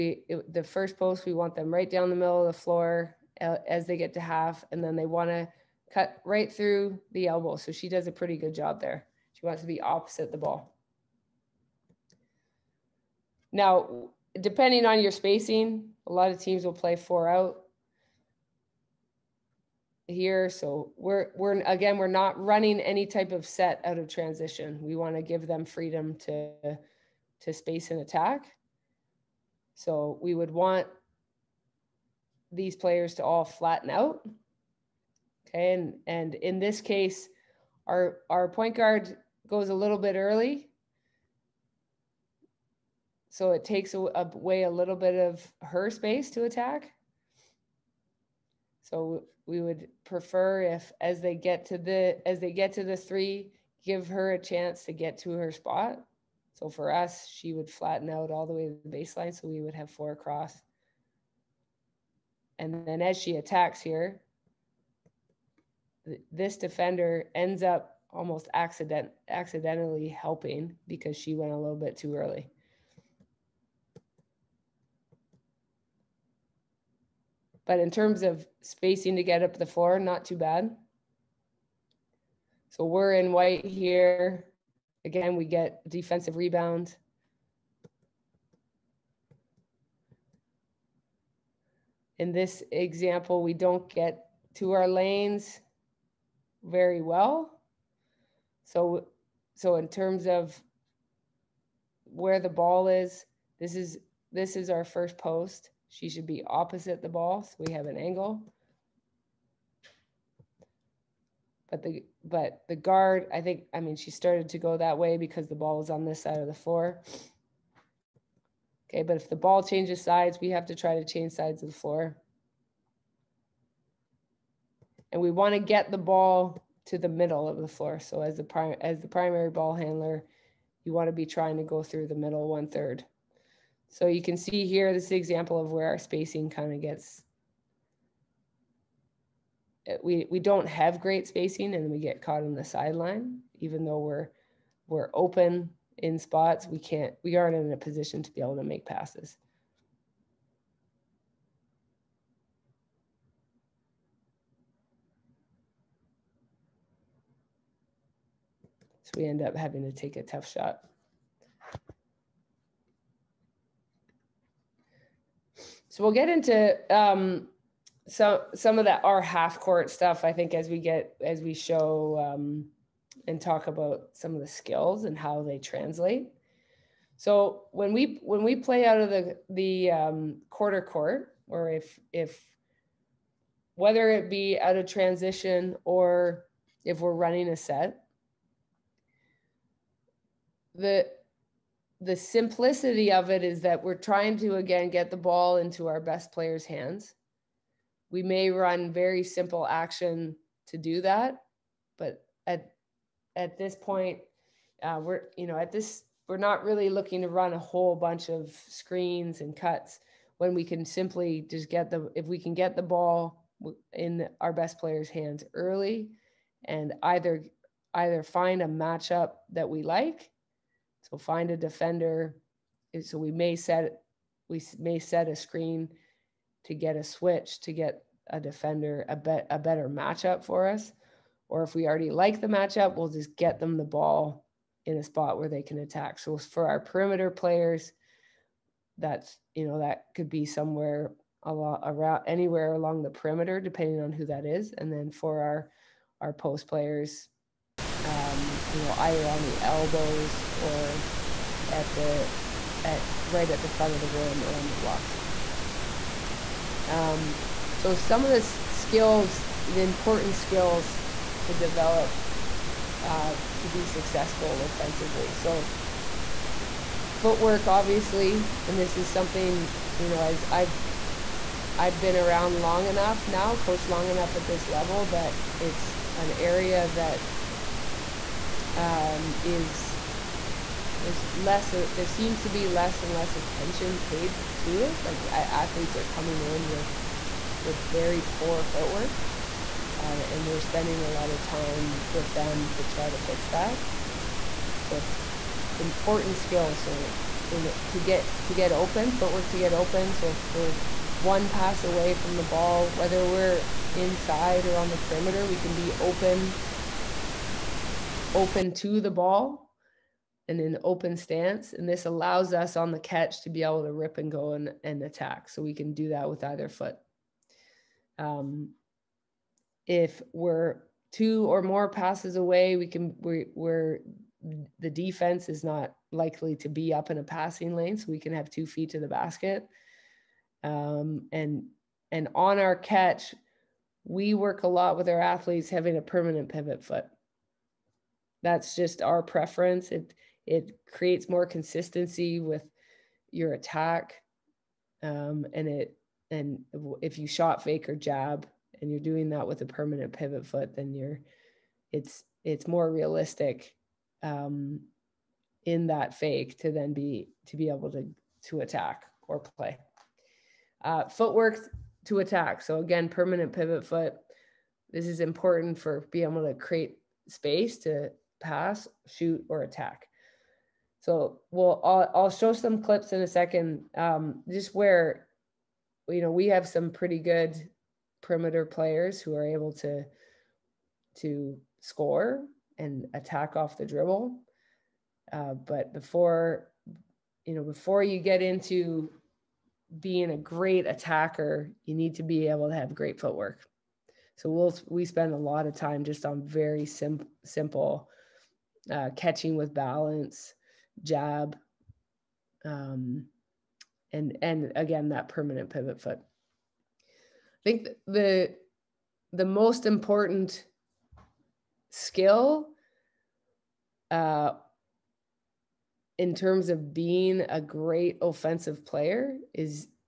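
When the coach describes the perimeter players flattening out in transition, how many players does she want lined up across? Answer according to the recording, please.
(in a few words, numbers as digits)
4.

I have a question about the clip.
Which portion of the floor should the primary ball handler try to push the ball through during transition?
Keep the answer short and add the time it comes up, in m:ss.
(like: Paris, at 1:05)
The middle one third, at 2:12.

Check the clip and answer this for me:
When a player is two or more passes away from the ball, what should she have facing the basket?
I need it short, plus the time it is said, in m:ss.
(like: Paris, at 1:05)
Two feet, at 5:28.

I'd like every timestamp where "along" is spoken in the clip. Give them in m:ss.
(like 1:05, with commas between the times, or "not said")
4:02.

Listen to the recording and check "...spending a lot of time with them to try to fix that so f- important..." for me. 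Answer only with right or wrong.
right.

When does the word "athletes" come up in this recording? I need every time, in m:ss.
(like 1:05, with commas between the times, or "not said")
4:45, 5:35.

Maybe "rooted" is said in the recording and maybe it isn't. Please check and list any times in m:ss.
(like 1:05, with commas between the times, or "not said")
not said.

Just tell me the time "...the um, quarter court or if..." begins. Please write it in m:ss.
2:59.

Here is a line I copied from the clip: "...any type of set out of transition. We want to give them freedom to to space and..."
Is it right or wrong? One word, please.
right.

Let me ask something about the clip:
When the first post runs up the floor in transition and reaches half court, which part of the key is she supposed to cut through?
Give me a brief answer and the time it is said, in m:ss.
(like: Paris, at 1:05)
The elbow, at 0:07.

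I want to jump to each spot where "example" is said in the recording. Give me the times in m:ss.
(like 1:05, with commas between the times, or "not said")
1:32, 2:15.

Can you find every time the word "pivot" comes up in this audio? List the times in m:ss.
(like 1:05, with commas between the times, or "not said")
5:36, 5:50, 6:03, 6:45.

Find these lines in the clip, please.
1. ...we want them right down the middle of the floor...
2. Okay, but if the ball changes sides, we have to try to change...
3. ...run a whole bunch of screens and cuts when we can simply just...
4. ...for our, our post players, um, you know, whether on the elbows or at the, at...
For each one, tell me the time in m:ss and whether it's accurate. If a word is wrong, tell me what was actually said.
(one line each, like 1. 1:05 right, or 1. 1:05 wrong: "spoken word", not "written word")
1. 0:01 right
2. 1:58 right
3. 3:27 right
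4. 4:05 wrong: "either", not "whether".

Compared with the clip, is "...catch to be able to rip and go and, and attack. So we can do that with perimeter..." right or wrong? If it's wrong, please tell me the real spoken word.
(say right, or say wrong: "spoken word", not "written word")
wrong: "either", not "perimeter".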